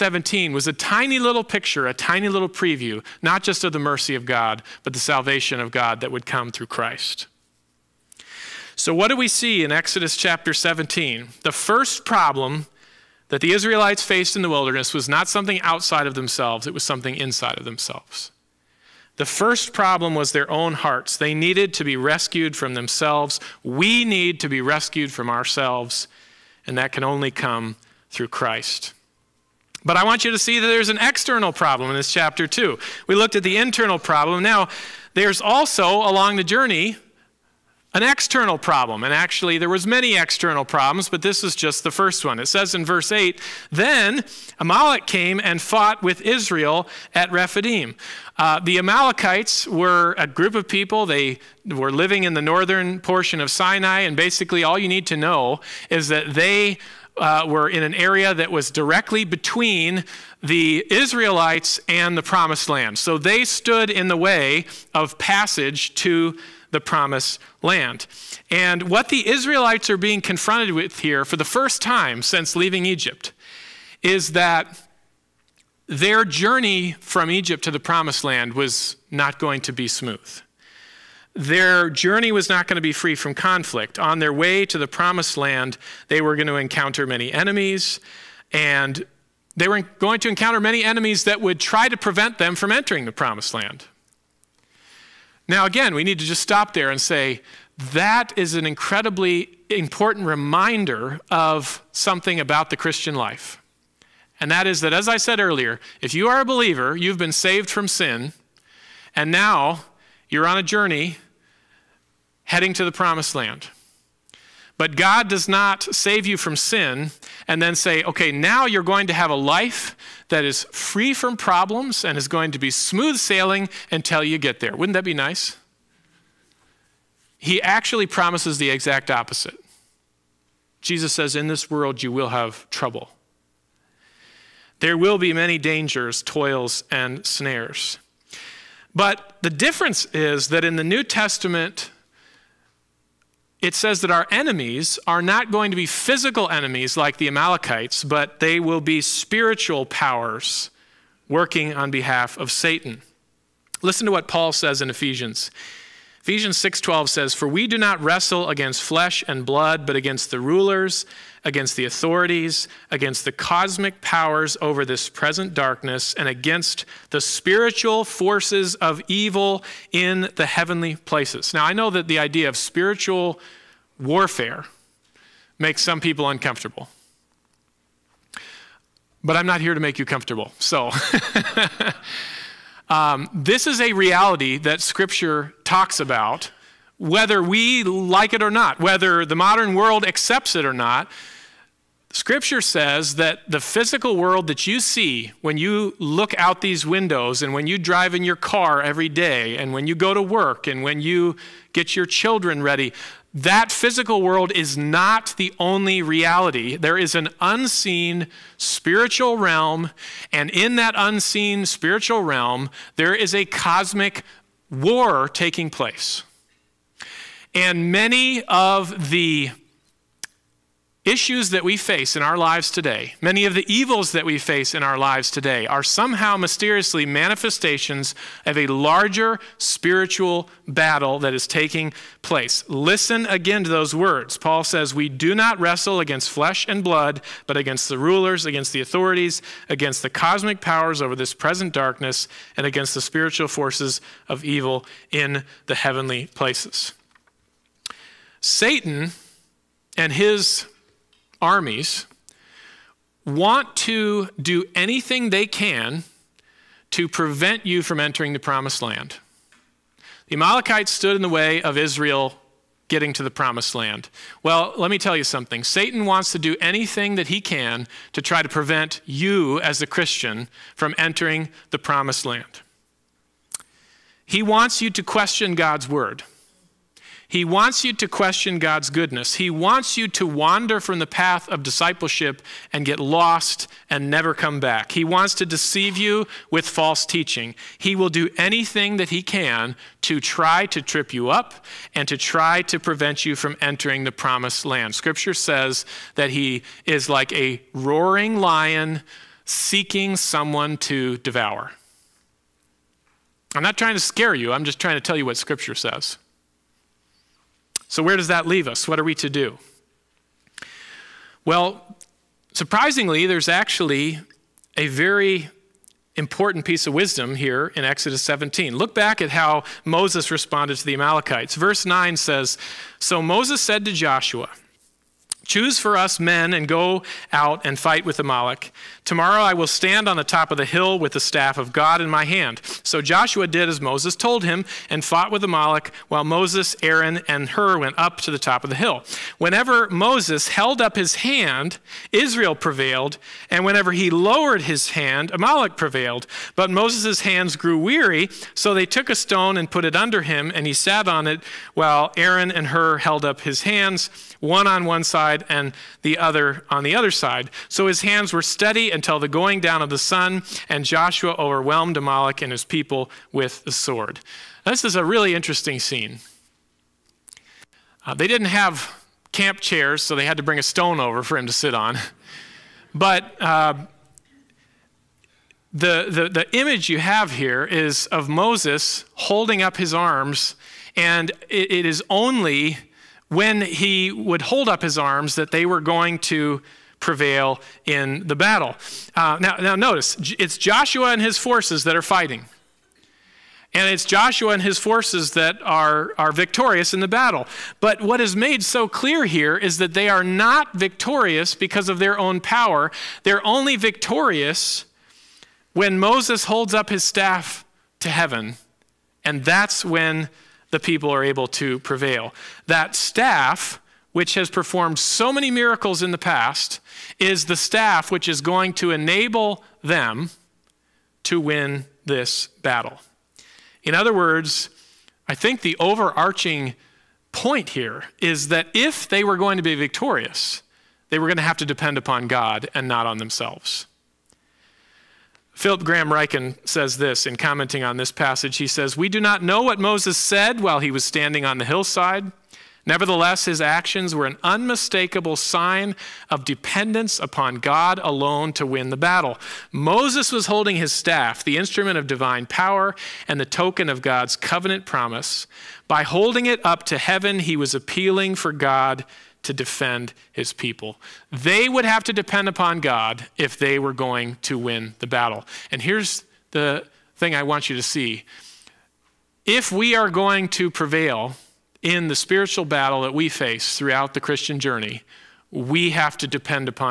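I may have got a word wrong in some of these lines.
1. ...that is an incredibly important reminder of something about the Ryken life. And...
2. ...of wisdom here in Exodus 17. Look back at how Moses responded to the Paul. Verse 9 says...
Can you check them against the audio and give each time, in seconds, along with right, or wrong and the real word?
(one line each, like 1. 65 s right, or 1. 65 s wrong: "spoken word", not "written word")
1. 97 s wrong: "Christian", not "Ryken"
2. 316 s wrong: "Amalekites", not "Paul".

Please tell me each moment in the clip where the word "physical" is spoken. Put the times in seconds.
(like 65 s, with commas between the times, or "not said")
145 s, 193 s, 203 s.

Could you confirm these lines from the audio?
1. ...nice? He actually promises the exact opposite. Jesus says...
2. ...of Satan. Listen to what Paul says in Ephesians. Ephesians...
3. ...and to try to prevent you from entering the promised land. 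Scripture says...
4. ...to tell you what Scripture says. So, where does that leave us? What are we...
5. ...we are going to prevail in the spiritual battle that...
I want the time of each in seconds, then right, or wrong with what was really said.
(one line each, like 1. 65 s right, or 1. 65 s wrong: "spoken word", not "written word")
1. 125 s right
2. 152 s right
3. 291 s right
4. 304 s right
5. 469 s right.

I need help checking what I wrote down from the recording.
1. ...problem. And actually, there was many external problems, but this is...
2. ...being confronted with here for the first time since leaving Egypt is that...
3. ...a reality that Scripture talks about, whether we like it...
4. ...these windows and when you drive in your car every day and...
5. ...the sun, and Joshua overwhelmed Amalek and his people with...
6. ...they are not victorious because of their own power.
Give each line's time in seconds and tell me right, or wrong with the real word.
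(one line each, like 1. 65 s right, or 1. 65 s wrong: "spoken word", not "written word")
1. 38 s right
2. 69 s right
3. 183 s right
4. 196 s right
5. 359 s right
6. 399 s right.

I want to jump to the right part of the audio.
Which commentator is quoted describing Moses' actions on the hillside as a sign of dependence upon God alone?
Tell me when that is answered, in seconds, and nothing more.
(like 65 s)
435 s.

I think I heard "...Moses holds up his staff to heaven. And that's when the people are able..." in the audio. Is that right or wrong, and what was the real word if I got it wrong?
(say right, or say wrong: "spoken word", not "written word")
right.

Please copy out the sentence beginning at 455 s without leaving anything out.
By holding it up to heaven, he was appealing for God to defend his people.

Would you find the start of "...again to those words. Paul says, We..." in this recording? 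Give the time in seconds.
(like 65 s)
233 s.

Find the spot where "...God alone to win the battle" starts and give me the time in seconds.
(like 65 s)
447 s.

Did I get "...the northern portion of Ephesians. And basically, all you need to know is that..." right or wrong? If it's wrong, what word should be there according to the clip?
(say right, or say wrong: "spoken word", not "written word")
wrong: "Sinai", not "Ephesians".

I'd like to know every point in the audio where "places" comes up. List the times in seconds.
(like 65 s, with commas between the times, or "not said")
170 s, 215 s, 232 s, 246 s.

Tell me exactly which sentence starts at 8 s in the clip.
So, what do we see in Exodus chapter 17?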